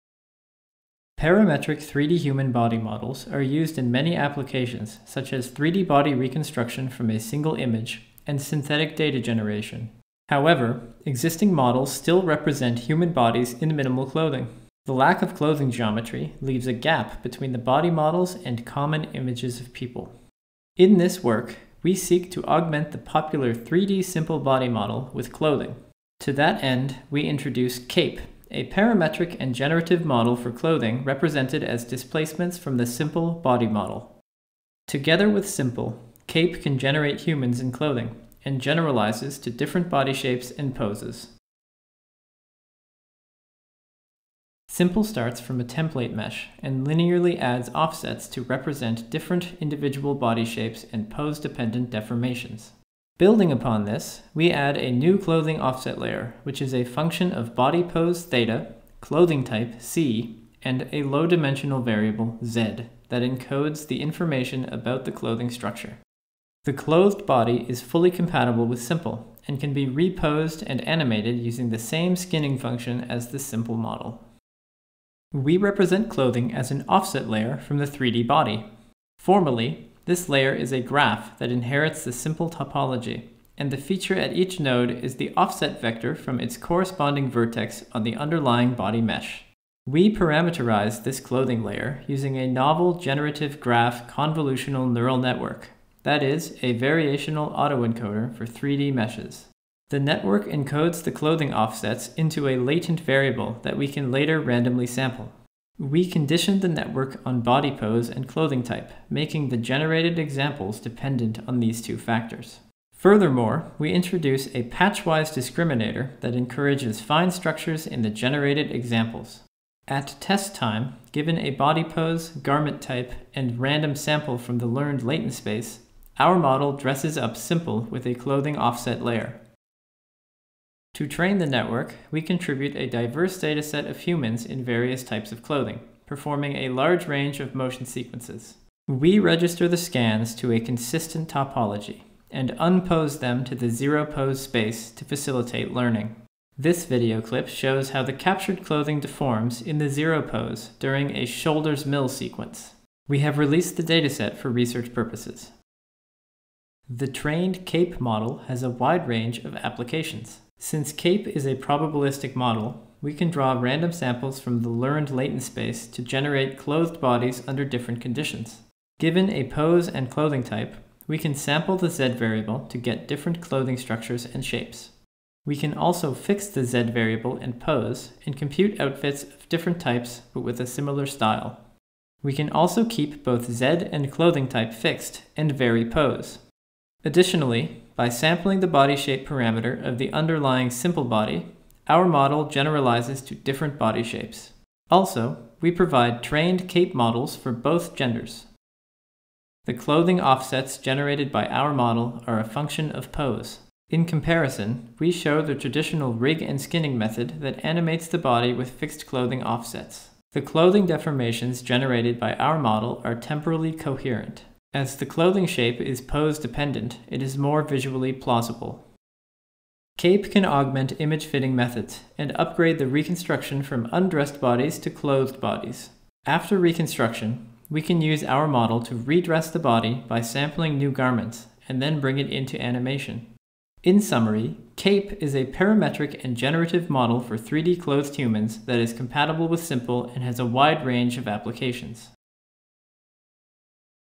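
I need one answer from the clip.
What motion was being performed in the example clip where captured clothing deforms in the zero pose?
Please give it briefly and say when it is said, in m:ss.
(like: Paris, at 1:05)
Shoulders mill, at 2:31.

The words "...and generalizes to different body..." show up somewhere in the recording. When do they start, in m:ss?
0:38.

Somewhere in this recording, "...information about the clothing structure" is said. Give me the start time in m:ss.
1:04.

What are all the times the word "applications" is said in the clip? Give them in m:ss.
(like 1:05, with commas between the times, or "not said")
0:04, 2:39, 4:01.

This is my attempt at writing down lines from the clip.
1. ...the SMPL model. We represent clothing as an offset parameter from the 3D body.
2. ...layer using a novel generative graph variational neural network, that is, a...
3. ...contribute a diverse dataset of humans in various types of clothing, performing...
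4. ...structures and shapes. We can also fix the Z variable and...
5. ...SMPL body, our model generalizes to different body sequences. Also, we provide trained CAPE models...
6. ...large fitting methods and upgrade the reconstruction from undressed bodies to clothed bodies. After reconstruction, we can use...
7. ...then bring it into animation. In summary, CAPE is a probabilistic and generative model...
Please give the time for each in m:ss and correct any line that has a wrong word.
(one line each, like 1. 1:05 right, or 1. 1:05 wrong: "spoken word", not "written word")
1. 1:13 wrong: "layer", not "parameter"
2. 1:31 wrong: "convolutional", not "variational"
3. 2:12 right
4. 2:53 right
5. 3:10 wrong: "shapes", not "sequences"
6. 3:40 wrong: "image", not "large"
7. 3:51 wrong: "parametric", not "probabilistic".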